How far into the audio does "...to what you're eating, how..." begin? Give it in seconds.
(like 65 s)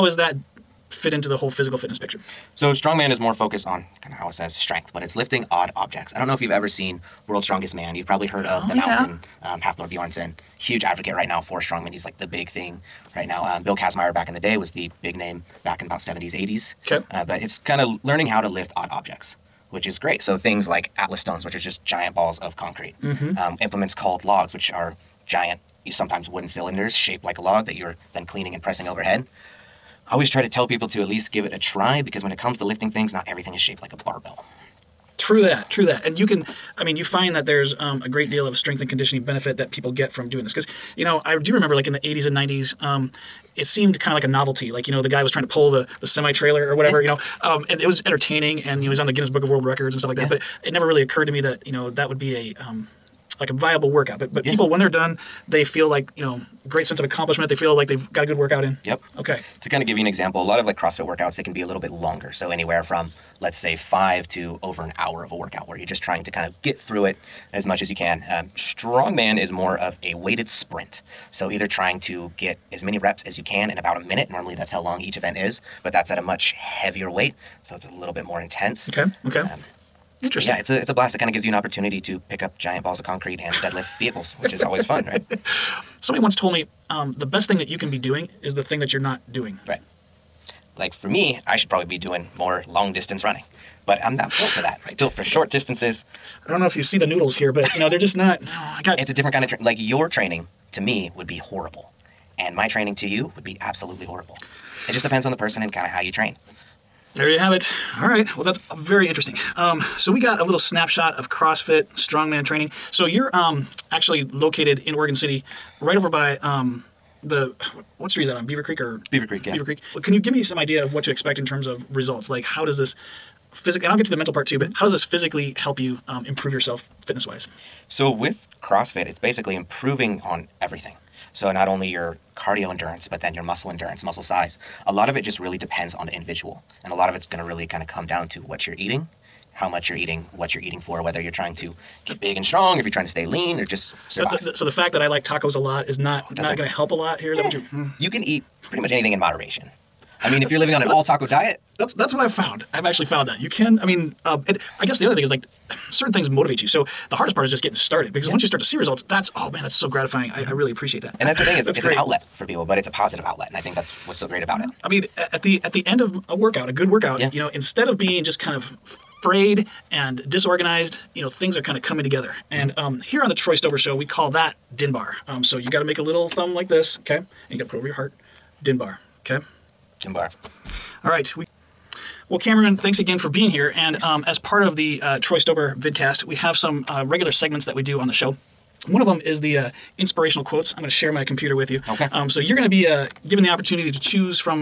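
138 s.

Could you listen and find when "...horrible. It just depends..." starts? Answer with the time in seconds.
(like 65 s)
104 s.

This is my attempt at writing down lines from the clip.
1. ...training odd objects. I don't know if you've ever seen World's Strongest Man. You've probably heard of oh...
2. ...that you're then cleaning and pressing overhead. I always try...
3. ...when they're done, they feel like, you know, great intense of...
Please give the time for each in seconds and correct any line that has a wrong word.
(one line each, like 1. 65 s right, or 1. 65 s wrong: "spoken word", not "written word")
1. 5 s wrong: "lifting", not "training"
2. 27 s right
3. 54 s wrong: "sense", not "intense".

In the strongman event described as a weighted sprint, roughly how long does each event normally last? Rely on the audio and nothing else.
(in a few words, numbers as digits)
1 minute.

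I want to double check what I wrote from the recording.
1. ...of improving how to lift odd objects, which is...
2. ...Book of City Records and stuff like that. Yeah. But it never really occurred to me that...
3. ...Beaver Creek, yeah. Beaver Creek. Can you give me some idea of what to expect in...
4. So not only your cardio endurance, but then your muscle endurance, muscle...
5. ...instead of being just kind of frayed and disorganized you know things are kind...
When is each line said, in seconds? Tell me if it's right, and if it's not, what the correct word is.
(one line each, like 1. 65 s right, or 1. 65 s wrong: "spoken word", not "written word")
1. 17 s wrong: "learning", not "improving"
2. 49 s wrong: "World", not "City"
3. 119 s right
4. 131 s right
5. 167 s right.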